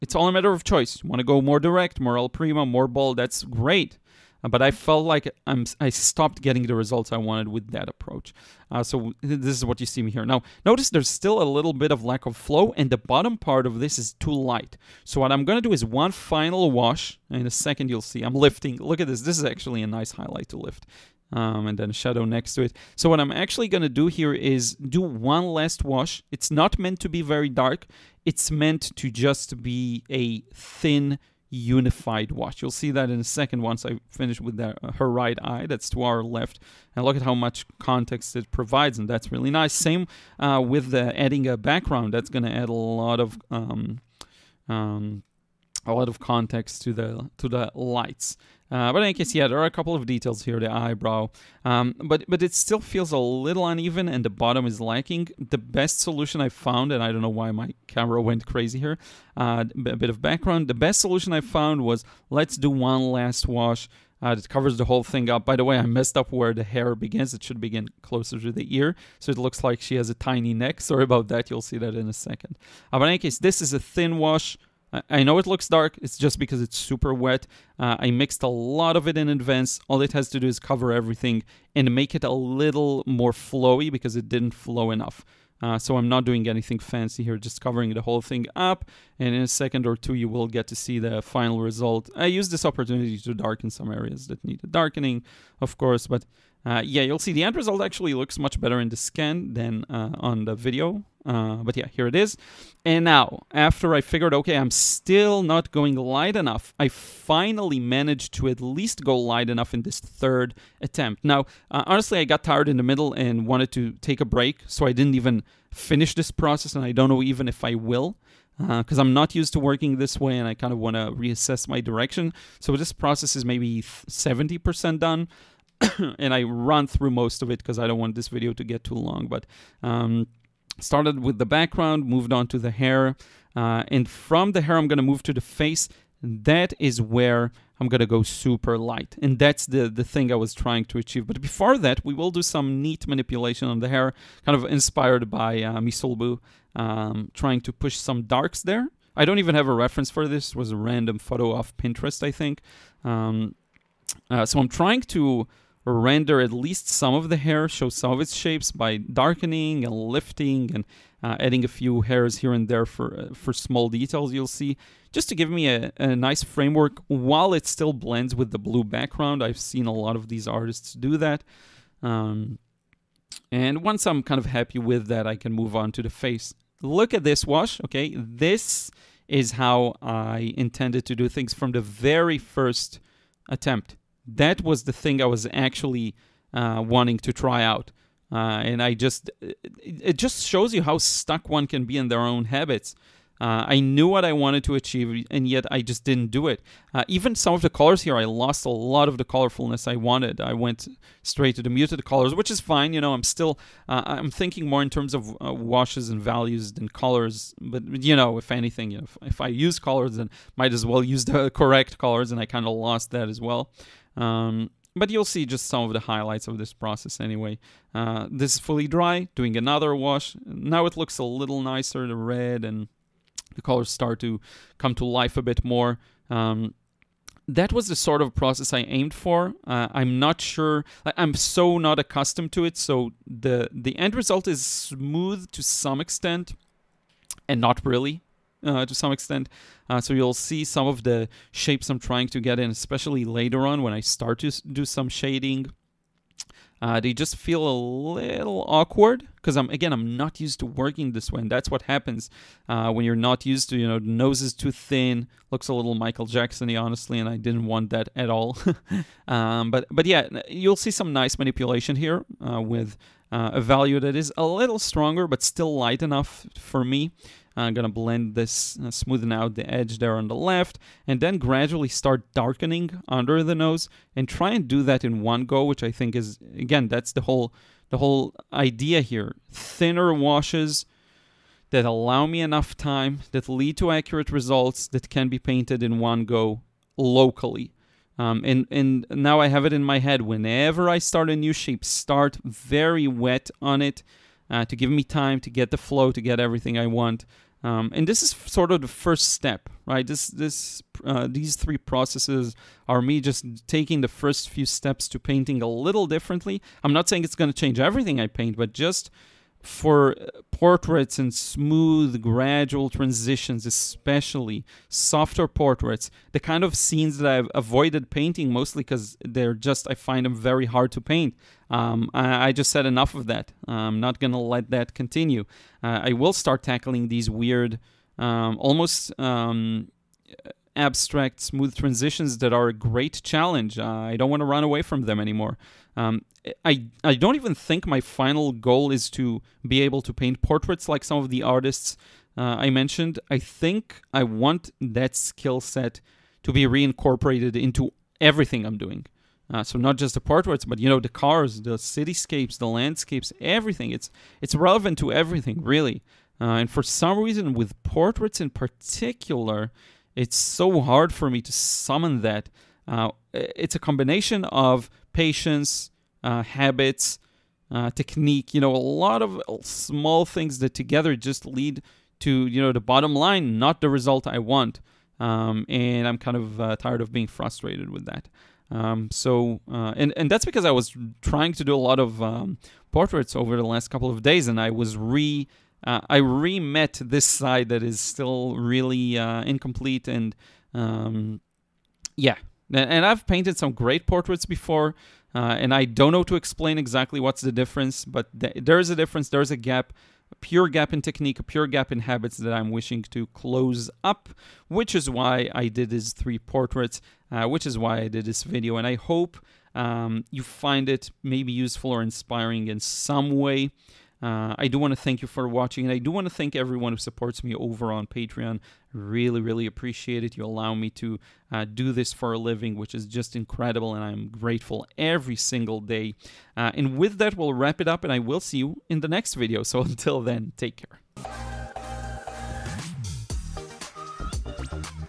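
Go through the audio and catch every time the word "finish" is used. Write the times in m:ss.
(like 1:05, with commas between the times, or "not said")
0:34, 1:55.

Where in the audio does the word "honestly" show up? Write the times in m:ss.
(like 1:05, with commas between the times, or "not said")
1:51, 4:16.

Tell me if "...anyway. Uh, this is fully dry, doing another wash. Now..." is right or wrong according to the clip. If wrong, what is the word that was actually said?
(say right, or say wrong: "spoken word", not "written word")
right.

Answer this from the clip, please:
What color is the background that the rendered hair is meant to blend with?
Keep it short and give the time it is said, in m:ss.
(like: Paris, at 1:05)
Blue, at 2:48.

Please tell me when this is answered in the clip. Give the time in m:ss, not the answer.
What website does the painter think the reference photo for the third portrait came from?
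2:31.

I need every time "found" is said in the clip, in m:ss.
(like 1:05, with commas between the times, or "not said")
0:56, 1:01.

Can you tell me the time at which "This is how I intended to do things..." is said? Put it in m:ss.
2:58.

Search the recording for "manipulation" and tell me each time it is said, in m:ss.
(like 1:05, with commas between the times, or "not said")
2:23, 4:21.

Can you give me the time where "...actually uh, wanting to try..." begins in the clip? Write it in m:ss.
3:05.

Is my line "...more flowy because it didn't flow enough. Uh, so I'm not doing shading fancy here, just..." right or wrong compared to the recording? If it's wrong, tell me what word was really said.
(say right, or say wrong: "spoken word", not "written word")
wrong: "anything", not "shading".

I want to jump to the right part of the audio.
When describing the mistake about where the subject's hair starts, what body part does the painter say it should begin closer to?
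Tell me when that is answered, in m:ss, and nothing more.
1:08.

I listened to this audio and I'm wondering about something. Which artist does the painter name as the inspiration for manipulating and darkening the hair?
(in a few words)
Misolbu.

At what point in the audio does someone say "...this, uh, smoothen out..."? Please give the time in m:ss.
4:28.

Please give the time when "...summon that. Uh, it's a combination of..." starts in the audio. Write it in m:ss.
6:01.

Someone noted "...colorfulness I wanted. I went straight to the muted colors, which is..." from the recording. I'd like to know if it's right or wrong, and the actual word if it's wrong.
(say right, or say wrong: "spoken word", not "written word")
right.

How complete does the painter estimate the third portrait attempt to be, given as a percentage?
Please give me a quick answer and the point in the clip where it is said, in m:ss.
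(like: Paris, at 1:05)
70%, at 2:03.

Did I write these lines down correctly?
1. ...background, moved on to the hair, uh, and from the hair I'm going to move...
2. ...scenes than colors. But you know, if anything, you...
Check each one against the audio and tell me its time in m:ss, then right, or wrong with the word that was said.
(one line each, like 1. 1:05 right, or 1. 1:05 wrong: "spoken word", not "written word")
1. 2:11 right
2. 3:26 wrong: "values", not "scenes".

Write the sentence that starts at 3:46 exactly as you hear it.
Um, that was the sort of process I aimed for.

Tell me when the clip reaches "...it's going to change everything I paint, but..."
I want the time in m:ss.
5:07.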